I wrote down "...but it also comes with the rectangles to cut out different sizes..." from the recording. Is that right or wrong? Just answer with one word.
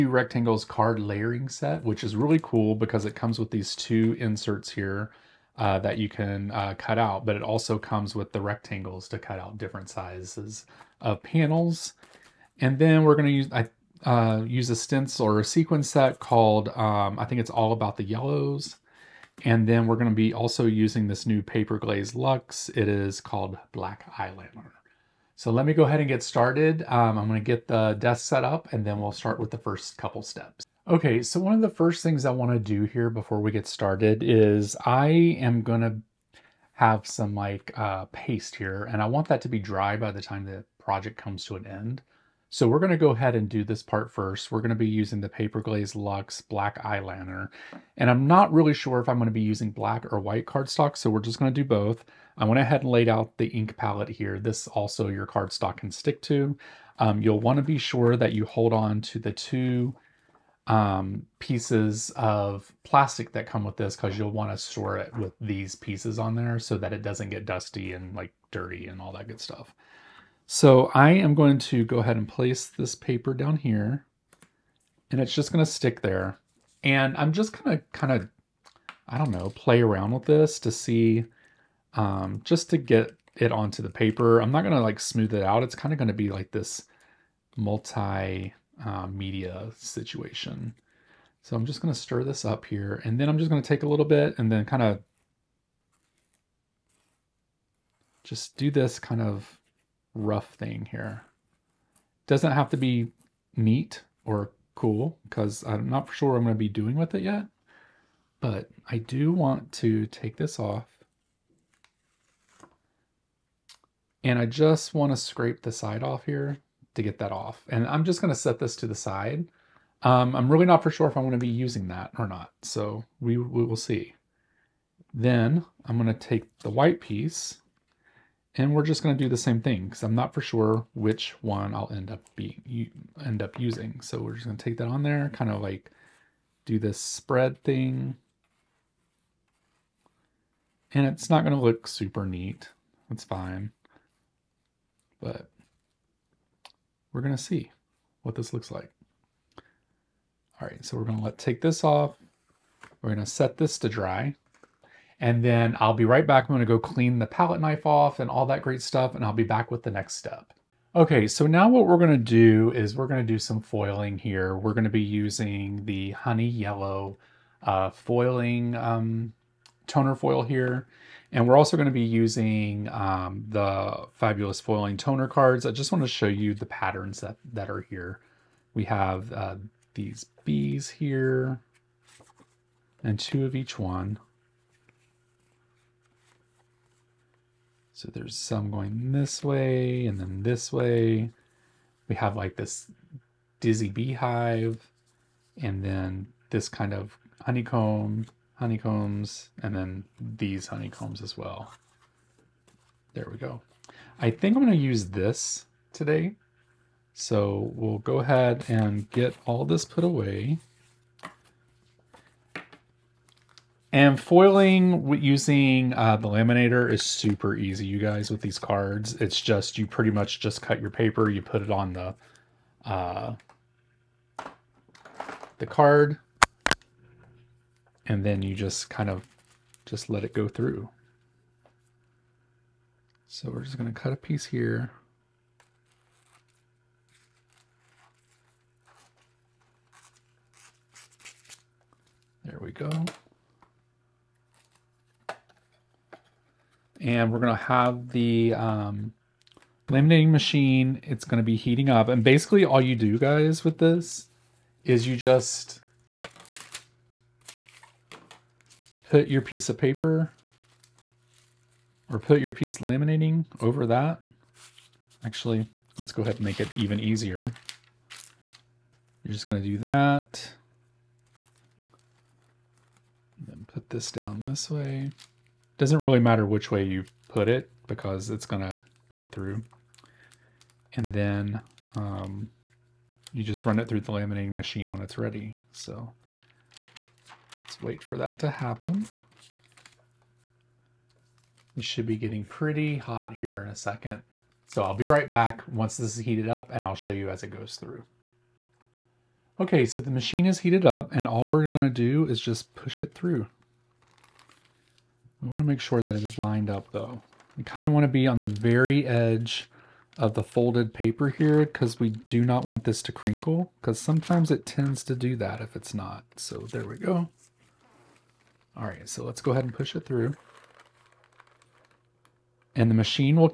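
right.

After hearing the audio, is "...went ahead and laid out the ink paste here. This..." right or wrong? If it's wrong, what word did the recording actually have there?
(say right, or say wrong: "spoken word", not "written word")
wrong: "palette", not "paste".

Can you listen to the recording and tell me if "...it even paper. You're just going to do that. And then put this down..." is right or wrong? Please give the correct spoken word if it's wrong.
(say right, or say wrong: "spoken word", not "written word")
wrong: "easier", not "paper".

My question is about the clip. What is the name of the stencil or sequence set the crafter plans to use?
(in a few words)
All About the Yellows.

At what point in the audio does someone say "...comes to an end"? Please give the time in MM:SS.
00:41.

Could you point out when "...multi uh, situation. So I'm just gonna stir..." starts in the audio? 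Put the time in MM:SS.
01:27.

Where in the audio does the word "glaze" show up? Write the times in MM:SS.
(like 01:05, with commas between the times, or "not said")
00:21, 00:45.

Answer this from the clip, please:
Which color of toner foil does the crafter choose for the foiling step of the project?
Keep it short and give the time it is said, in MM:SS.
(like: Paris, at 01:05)
honey yellow, at 02:46.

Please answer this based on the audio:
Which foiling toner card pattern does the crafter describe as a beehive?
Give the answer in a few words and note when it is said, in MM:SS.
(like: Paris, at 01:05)
dizzy beehive, at 03:13.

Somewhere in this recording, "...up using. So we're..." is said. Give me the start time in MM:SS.
02:13.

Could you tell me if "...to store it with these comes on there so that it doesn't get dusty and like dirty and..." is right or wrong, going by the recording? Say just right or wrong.
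wrong.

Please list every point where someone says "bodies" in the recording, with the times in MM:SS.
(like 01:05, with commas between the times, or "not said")
not said.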